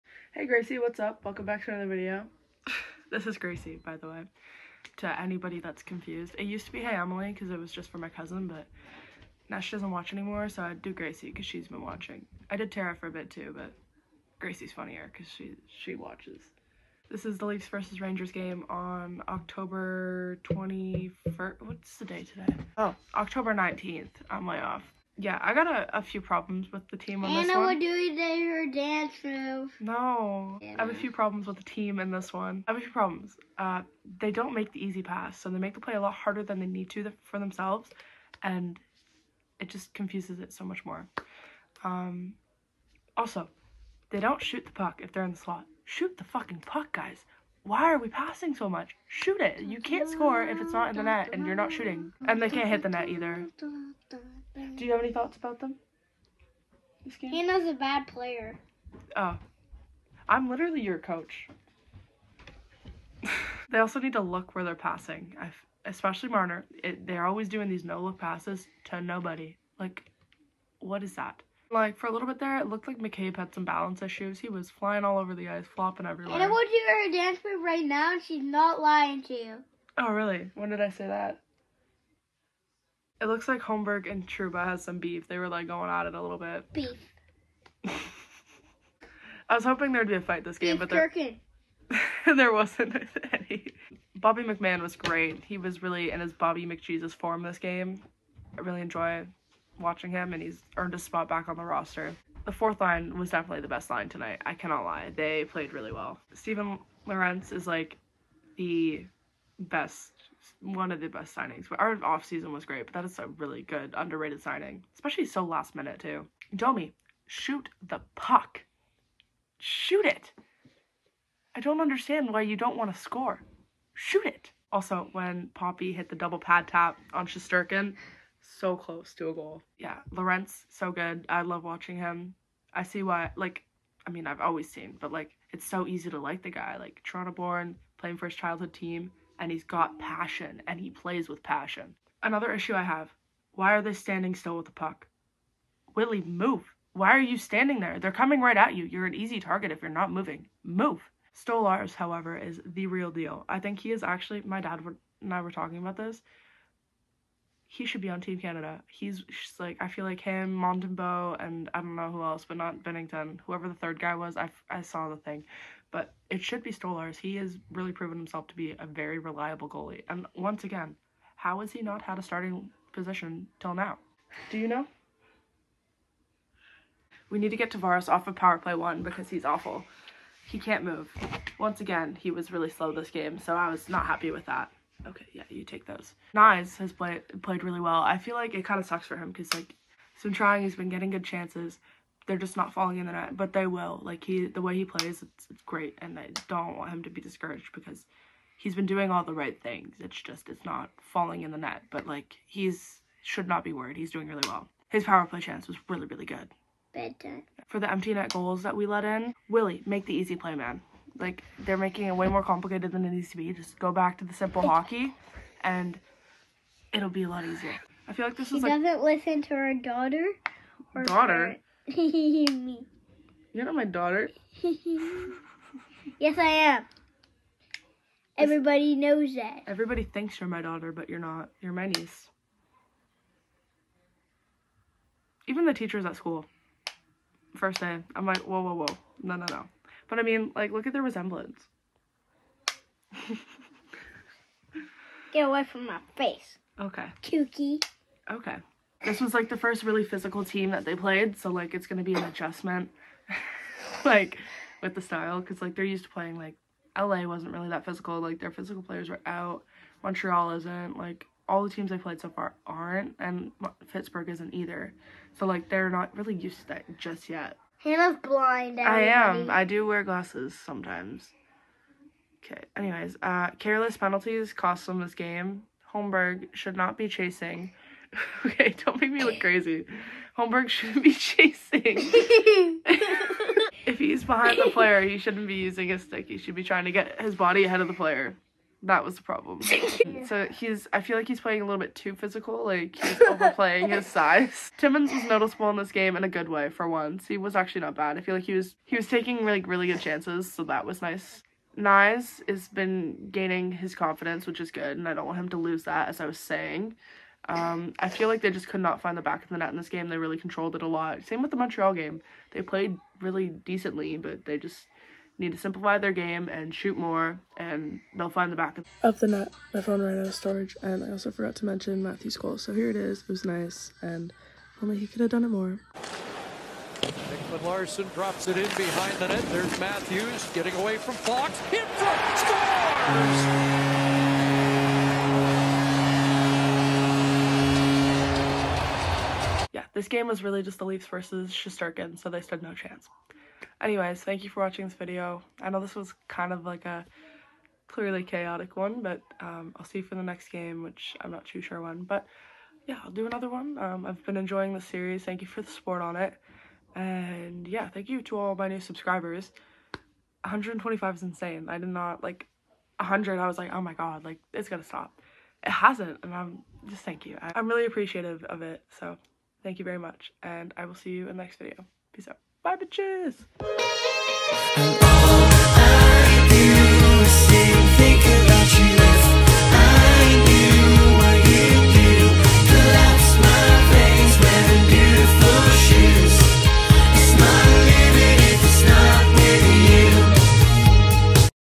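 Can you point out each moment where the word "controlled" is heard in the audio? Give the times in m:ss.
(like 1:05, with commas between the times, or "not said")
5:10.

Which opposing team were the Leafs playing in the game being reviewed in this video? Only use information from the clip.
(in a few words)
Rangers.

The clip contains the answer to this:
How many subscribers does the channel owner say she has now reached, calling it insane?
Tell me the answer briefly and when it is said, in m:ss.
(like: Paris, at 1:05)
125, at 6:00.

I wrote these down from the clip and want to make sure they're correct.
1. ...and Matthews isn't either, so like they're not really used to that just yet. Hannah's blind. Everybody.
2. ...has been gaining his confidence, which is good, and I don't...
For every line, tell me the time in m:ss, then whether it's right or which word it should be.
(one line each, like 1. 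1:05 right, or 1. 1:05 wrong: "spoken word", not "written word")
1. 4:23 wrong: "Pittsburgh", not "Matthews"
2. 5:02 right.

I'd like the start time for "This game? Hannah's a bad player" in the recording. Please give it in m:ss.
0:57.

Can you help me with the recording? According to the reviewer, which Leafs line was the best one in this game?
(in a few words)
The fourth line.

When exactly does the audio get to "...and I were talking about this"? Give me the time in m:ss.
2:35.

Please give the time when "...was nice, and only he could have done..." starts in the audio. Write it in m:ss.
5:23.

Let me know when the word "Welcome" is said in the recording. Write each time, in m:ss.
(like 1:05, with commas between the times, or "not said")
0:01.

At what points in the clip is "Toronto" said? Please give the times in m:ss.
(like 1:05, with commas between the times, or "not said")
2:17.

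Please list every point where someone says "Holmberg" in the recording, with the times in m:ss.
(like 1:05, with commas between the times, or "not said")
1:23, 4:35, 4:40.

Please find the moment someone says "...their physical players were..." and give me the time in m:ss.
4:18.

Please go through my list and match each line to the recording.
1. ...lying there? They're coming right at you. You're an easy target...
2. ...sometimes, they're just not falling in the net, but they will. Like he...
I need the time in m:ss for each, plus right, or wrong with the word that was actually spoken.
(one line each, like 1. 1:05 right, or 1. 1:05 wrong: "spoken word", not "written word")
1. 2:27 wrong: "standing", not "lying"
2. 3:11 wrong: "chances", not "sometimes".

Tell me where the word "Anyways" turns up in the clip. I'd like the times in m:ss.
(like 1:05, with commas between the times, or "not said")
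4:32, 5:43.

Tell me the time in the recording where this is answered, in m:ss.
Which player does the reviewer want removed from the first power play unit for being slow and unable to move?
2:57.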